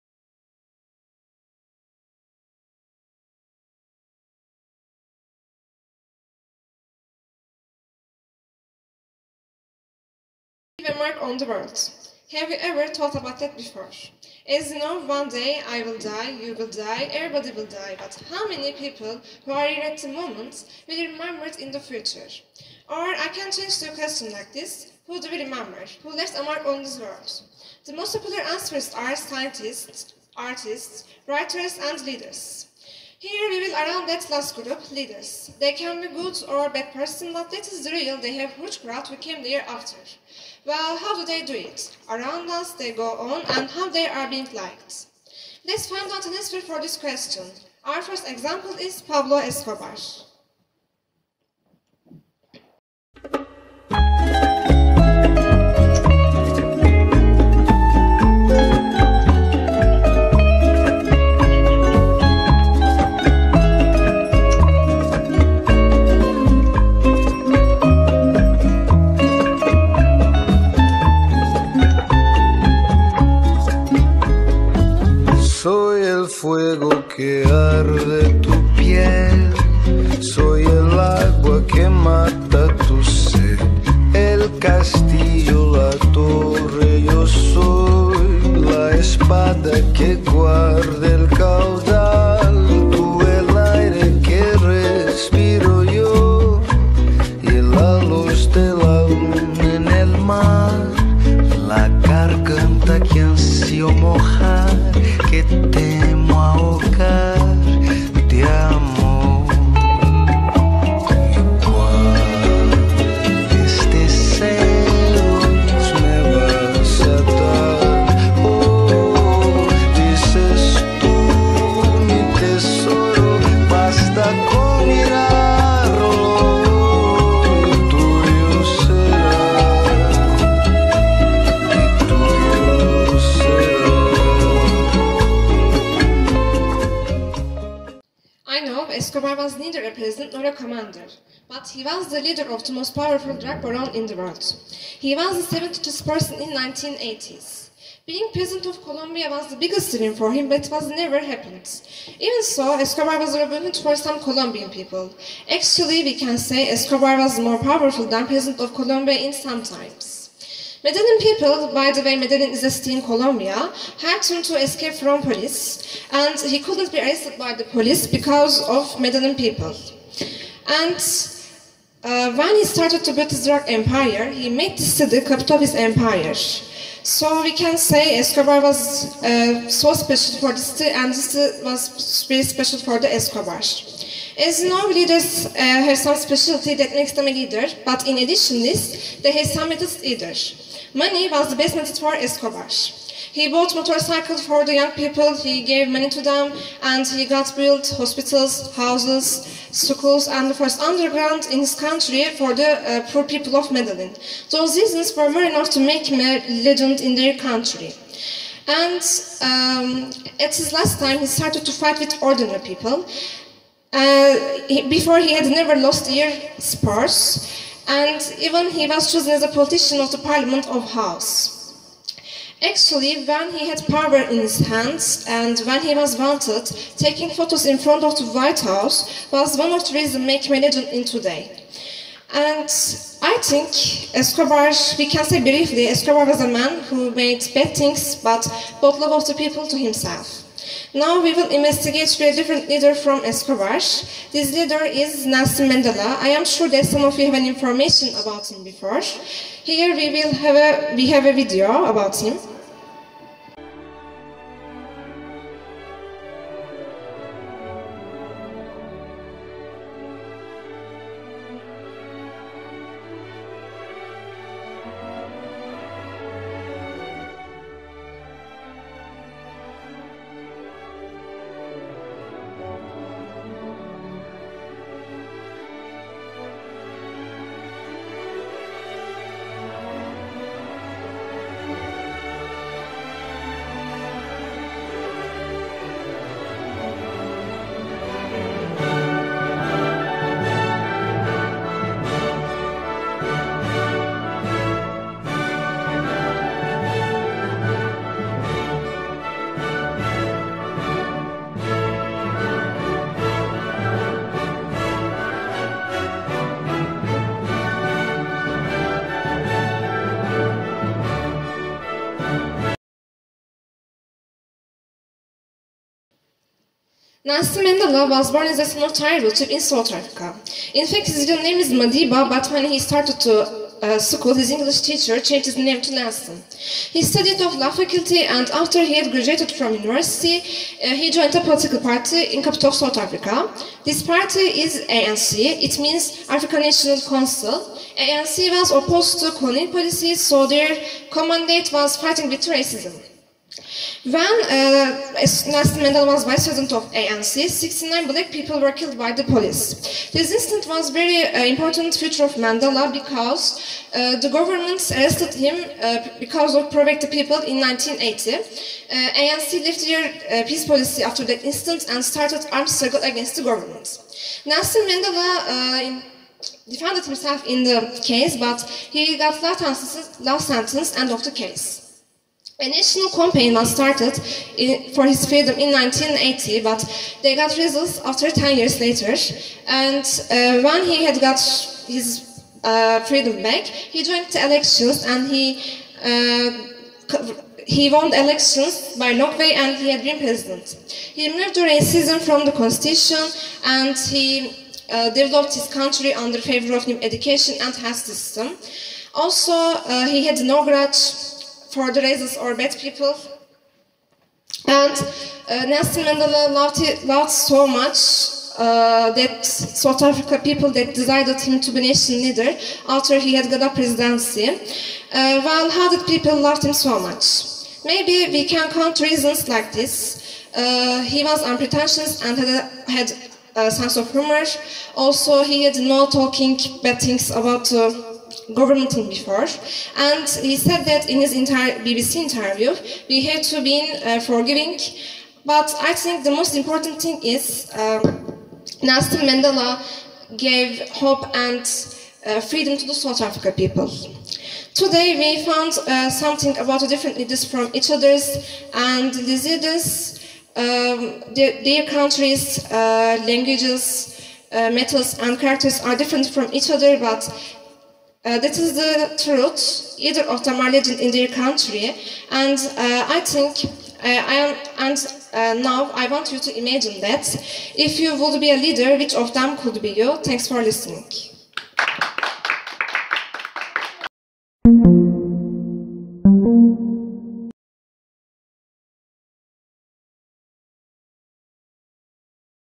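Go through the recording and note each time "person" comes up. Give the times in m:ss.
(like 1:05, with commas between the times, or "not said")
0:36, 2:26.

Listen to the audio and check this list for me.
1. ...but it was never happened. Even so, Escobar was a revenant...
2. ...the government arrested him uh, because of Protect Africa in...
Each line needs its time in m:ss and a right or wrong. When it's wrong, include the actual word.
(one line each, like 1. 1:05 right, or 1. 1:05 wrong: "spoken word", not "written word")
1. 2:30 right
2. 5:54 wrong: "People", not "Africa".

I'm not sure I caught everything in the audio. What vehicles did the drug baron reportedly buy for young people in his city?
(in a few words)
motorcycles.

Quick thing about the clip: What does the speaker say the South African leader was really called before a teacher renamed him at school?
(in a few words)
Madiba.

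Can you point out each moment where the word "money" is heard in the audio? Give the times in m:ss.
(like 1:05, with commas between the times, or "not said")
3:10, 3:15.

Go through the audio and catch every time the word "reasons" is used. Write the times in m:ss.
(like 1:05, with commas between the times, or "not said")
3:24, 3:49, 6:58.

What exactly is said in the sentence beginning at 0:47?
Our first example is Pablo Escobar.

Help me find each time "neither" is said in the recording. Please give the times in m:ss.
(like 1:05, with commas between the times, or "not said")
2:19.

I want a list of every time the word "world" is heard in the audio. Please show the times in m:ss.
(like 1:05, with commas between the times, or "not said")
0:11, 0:26, 2:24.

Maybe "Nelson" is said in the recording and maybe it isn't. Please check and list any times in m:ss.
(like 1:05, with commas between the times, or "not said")
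4:05, 5:17, 5:25, 5:45, 6:04, 6:45, 7:18.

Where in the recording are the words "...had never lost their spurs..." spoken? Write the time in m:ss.
3:35.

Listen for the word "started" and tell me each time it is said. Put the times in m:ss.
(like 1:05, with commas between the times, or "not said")
2:52, 3:31, 5:22, 6:02, 6:13.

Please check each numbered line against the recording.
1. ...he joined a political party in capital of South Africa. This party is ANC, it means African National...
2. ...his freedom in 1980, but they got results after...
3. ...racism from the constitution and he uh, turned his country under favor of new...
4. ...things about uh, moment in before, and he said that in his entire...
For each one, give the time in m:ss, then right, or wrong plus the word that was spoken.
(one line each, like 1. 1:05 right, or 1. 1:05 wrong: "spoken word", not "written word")
1. 5:30 right
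2. 6:15 right
3. 6:31 wrong: "developed", not "turned"
4. 7:06 wrong: "government", not "moment".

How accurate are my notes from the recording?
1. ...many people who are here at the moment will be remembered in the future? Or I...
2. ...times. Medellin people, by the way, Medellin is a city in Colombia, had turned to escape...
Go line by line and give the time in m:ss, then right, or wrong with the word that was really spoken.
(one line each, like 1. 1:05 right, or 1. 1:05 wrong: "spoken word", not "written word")
1. 0:18 right
2. 2:39 right.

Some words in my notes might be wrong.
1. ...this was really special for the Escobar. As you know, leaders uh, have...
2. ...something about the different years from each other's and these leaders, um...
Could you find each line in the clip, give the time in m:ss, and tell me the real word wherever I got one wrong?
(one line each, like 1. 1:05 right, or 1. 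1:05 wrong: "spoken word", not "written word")
1. 3:01 right
2. 7:26 wrong: "leaders", not "years".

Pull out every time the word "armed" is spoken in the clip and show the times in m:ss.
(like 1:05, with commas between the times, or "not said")
6:02.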